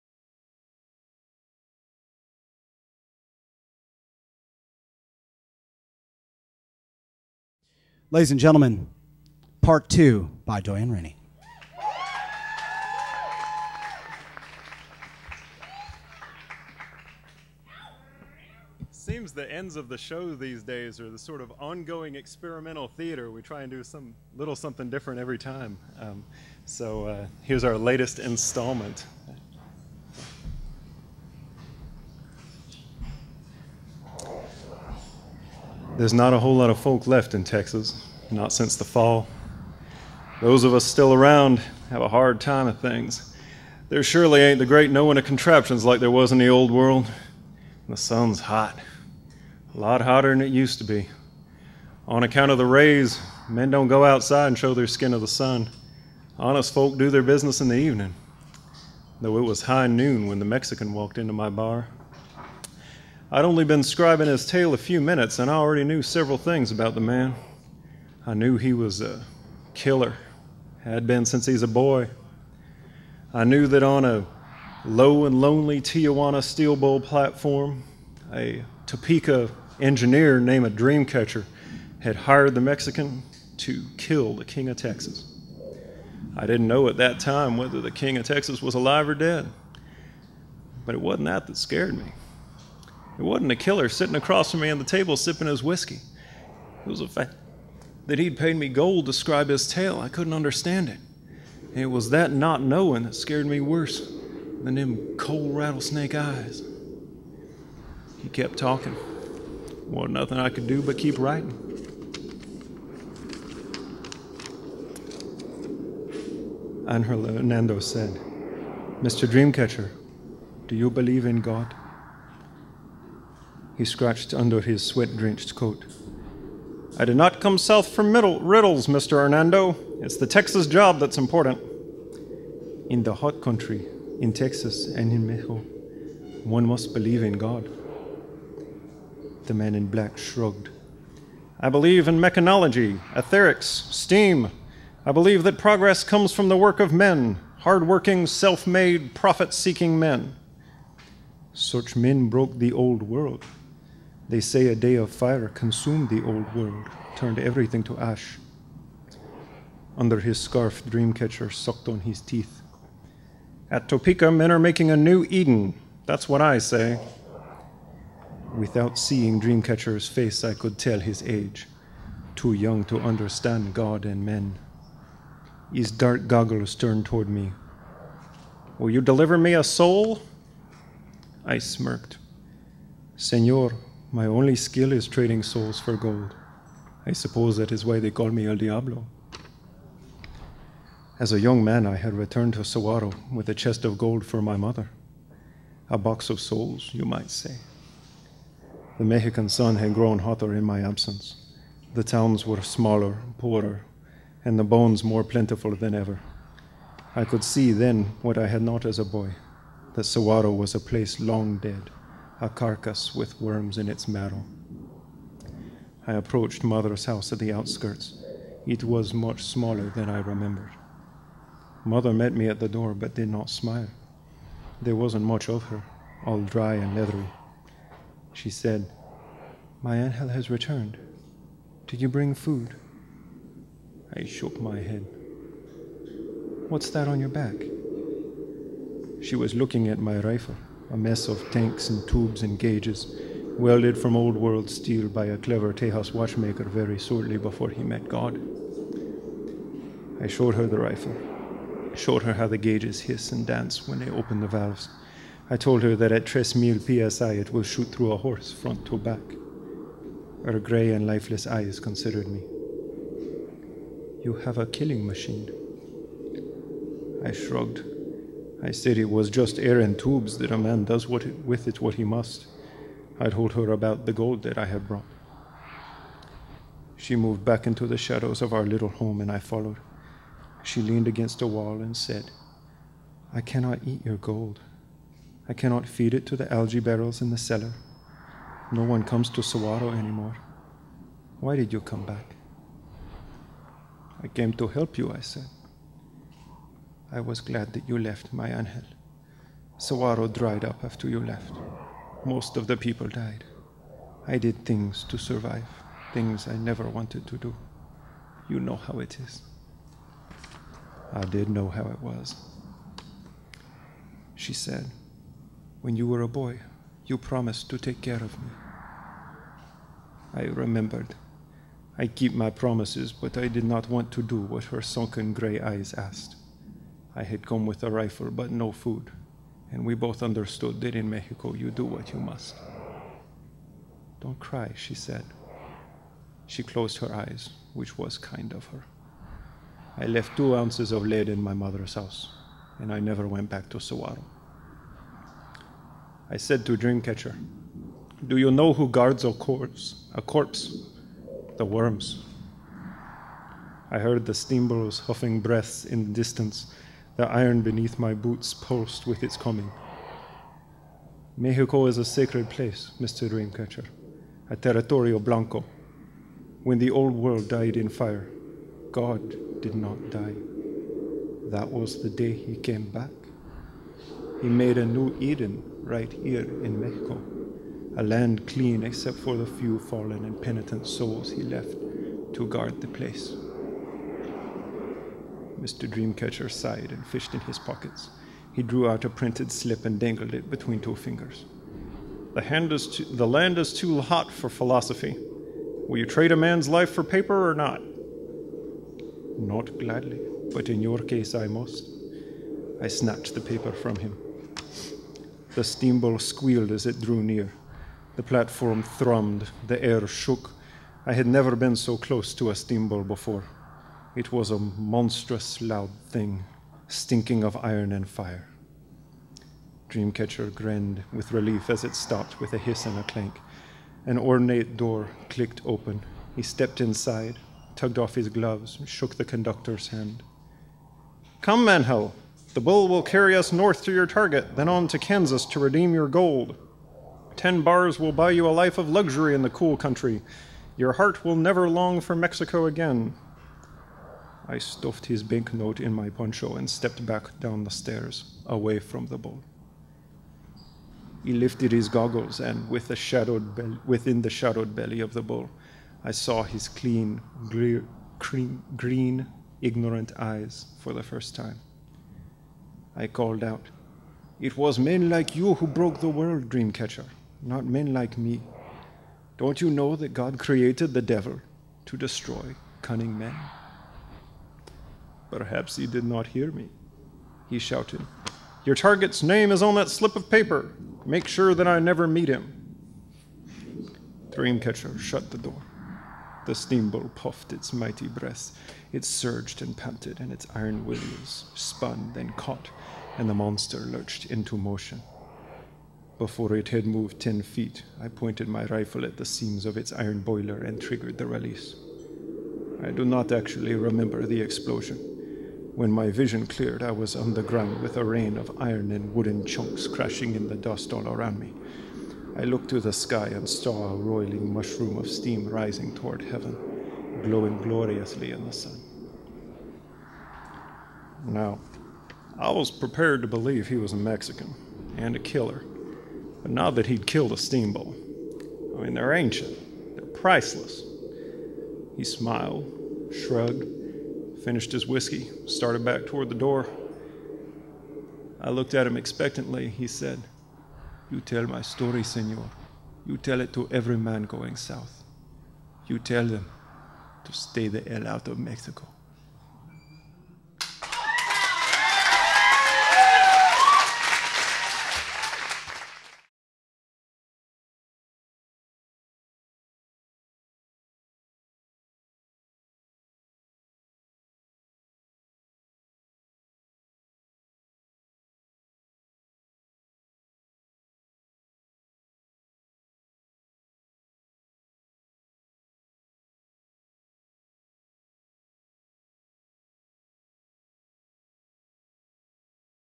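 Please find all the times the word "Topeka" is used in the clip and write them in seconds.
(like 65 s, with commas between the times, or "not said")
78 s, 163 s.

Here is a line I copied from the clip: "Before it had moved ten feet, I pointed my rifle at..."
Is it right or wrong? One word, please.
right.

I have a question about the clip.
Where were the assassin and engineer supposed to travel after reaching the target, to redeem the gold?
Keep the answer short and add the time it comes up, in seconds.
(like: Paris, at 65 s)
Kansas, at 434 s.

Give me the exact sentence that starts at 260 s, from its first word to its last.
Her gray and lifeless eyes considered me.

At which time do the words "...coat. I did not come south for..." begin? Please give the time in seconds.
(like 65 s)
125 s.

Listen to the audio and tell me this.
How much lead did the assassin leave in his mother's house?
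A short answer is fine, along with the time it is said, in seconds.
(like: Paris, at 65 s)
2 ounces, at 340 s.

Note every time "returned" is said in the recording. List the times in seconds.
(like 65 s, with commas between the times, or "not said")
192 s, 230 s.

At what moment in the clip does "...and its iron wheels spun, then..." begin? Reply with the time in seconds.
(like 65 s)
490 s.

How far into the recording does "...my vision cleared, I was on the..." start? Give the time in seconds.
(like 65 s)
505 s.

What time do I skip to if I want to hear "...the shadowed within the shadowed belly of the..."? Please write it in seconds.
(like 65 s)
452 s.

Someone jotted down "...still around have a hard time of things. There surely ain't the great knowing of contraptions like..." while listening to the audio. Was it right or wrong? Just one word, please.
right.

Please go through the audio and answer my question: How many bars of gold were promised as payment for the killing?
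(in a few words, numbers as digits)
10.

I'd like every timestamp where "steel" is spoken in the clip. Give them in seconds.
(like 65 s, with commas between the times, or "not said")
76 s, 244 s.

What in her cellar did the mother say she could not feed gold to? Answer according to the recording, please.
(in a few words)
algae barrels.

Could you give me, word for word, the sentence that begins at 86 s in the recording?
I didn't know at that time whether the King of Texas was alive or dead, but it wasn't that that scared me.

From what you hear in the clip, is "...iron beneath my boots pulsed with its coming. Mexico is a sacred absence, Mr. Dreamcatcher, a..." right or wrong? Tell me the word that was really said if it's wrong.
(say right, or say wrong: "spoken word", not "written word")
wrong: "place", not "absence".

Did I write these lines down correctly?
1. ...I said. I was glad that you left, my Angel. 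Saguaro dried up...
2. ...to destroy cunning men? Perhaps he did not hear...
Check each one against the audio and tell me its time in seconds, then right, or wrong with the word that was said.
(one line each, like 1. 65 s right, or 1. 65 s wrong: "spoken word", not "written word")
1. 295 s right
2. 471 s right.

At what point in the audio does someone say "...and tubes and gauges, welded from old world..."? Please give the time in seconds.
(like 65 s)
241 s.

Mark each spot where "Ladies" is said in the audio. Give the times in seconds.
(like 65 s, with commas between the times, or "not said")
8 s.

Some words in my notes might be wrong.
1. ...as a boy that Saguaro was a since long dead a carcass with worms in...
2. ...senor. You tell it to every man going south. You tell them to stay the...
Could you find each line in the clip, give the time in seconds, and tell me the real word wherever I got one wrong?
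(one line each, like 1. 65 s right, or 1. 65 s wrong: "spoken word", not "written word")
1. 208 s wrong: "place", not "since"
2. 542 s right.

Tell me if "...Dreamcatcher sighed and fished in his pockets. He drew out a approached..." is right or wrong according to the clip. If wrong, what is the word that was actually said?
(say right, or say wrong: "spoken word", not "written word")
wrong: "printed", not "approached".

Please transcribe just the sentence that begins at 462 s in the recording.
I called out, It was men like you who broke the world, Dreamcatcher, not men like me.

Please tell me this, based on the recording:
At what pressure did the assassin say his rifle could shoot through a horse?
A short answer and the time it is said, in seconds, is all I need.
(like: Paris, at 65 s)
3000 psi, at 256 s.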